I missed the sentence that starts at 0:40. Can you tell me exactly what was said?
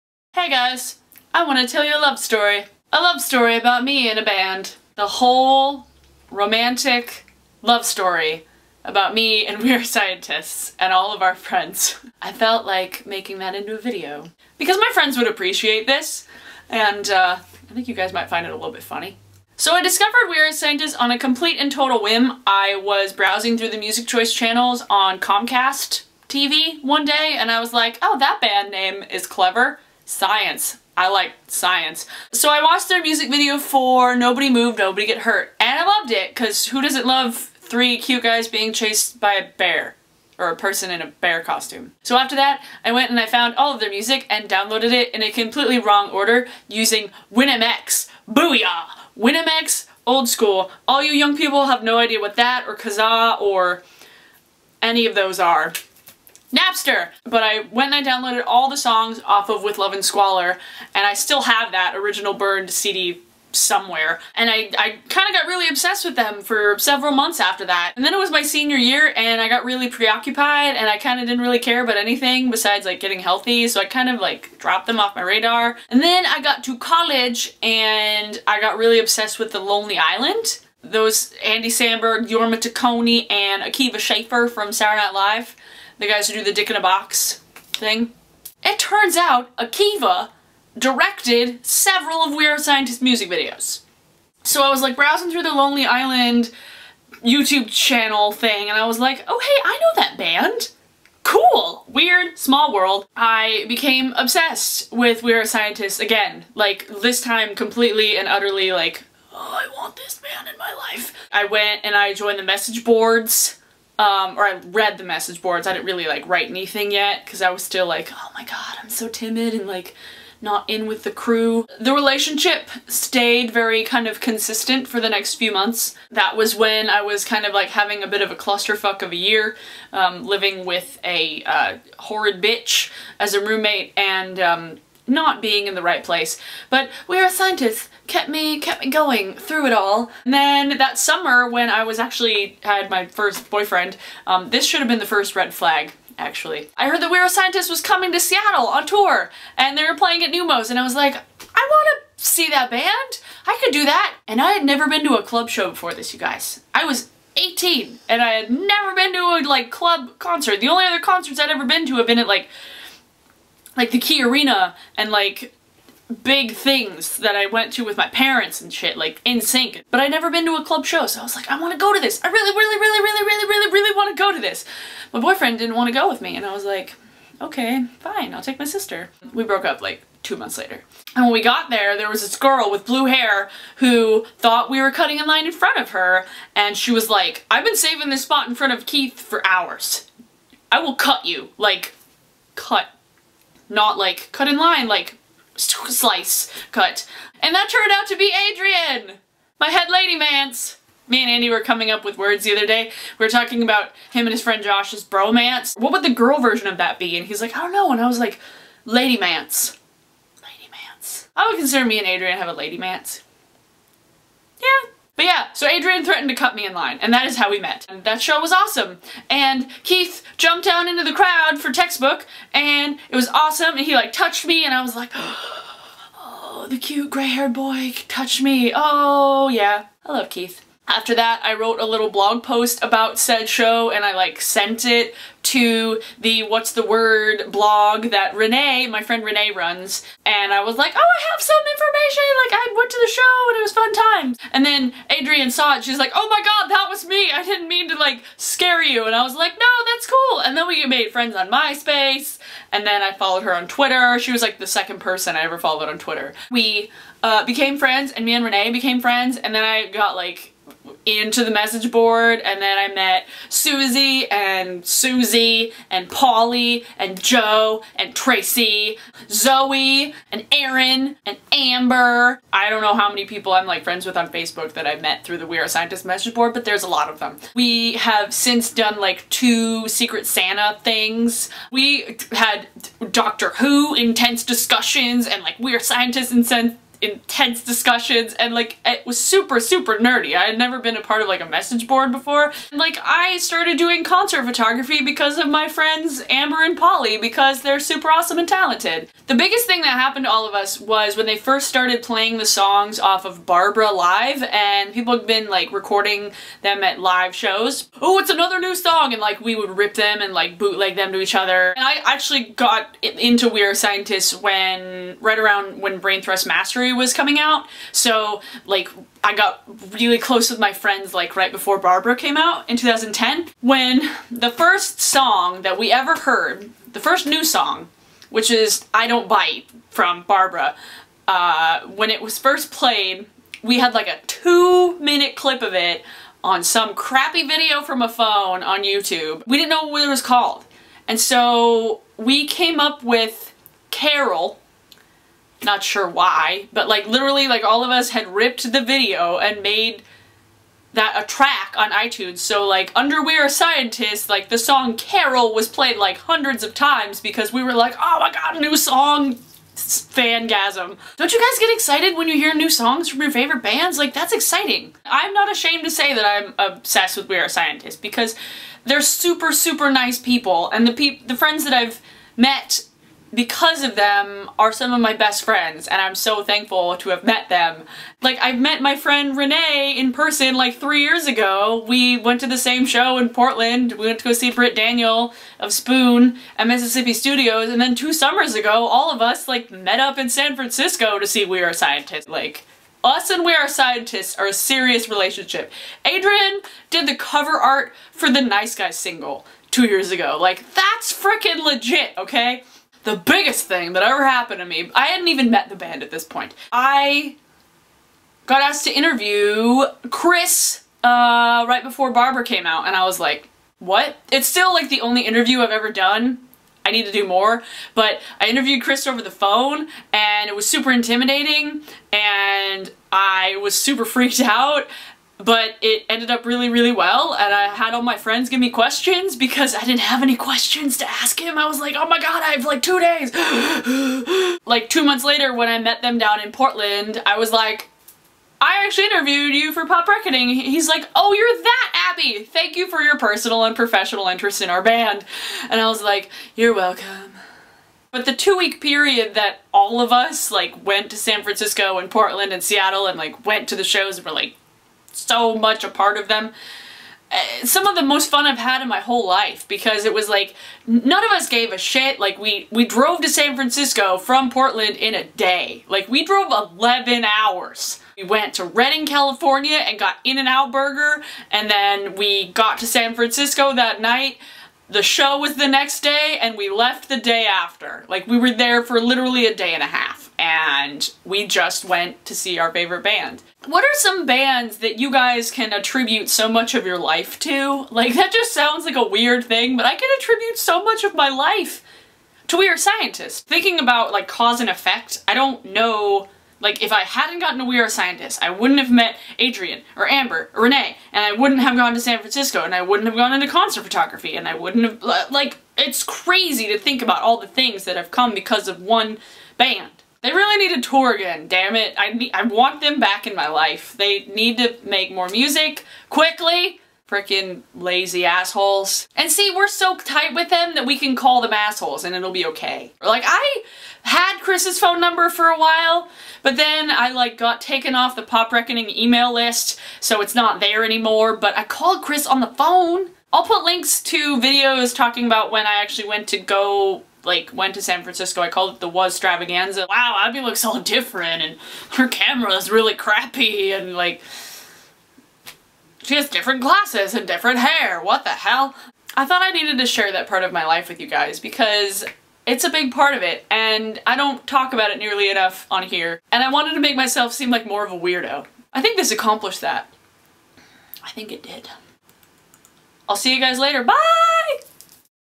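or a person in a bear costume.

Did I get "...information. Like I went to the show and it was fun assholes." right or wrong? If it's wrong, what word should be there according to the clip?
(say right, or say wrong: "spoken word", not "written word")
wrong: "times", not "assholes".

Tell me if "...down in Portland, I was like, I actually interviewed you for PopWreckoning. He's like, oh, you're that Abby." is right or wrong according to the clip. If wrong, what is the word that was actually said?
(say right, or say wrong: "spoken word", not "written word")
right.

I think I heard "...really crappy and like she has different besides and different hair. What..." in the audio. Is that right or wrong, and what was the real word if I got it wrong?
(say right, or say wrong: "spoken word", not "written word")
wrong: "glasses", not "besides".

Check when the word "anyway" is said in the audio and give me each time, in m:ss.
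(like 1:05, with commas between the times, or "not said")
not said.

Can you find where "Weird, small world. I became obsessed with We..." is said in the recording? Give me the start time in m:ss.
1:41.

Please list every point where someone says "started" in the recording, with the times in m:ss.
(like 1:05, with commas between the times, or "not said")
4:53, 5:01.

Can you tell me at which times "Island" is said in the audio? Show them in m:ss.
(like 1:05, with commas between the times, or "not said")
1:19, 1:35.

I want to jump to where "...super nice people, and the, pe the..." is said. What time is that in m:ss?
6:09.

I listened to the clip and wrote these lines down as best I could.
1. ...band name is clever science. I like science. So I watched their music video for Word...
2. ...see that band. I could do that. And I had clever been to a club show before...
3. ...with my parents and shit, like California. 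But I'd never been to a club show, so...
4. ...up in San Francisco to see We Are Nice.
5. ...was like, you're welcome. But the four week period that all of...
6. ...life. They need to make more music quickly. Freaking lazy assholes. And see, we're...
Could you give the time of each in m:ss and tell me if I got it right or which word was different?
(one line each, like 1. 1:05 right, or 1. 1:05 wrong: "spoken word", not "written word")
1. 0:28 wrong: "Nobody", not "Word"
2. 2:32 wrong: "never", not "clever"
3. 2:47 wrong: "NSYNC", not "California"
4. 6:29 wrong: "Scientists", not "Nice"
5. 7:25 wrong: "two", not "four"
6. 8:33 right.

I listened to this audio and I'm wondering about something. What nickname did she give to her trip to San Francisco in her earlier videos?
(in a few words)
Wastravaganza.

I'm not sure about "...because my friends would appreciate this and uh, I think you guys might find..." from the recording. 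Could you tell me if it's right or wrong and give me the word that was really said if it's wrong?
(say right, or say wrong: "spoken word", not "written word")
right.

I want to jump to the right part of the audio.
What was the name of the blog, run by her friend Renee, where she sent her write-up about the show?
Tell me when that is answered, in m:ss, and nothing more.
3:56.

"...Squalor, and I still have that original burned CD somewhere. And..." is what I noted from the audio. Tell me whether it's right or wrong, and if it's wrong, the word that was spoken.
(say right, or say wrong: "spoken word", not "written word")
right.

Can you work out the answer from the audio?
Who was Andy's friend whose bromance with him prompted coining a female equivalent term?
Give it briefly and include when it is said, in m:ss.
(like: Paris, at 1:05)
Josh, at 3:24.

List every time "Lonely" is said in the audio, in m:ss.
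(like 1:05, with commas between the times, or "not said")
1:19, 1:35.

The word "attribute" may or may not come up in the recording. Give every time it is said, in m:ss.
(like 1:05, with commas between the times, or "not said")
8:05, 8:10.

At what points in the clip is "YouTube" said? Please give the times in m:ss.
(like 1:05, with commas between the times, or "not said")
1:37, 5:38.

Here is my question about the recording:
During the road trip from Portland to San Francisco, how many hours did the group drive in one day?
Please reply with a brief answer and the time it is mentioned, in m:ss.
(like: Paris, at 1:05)
11, at 7:46.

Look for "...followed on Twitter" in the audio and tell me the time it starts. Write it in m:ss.
4:15.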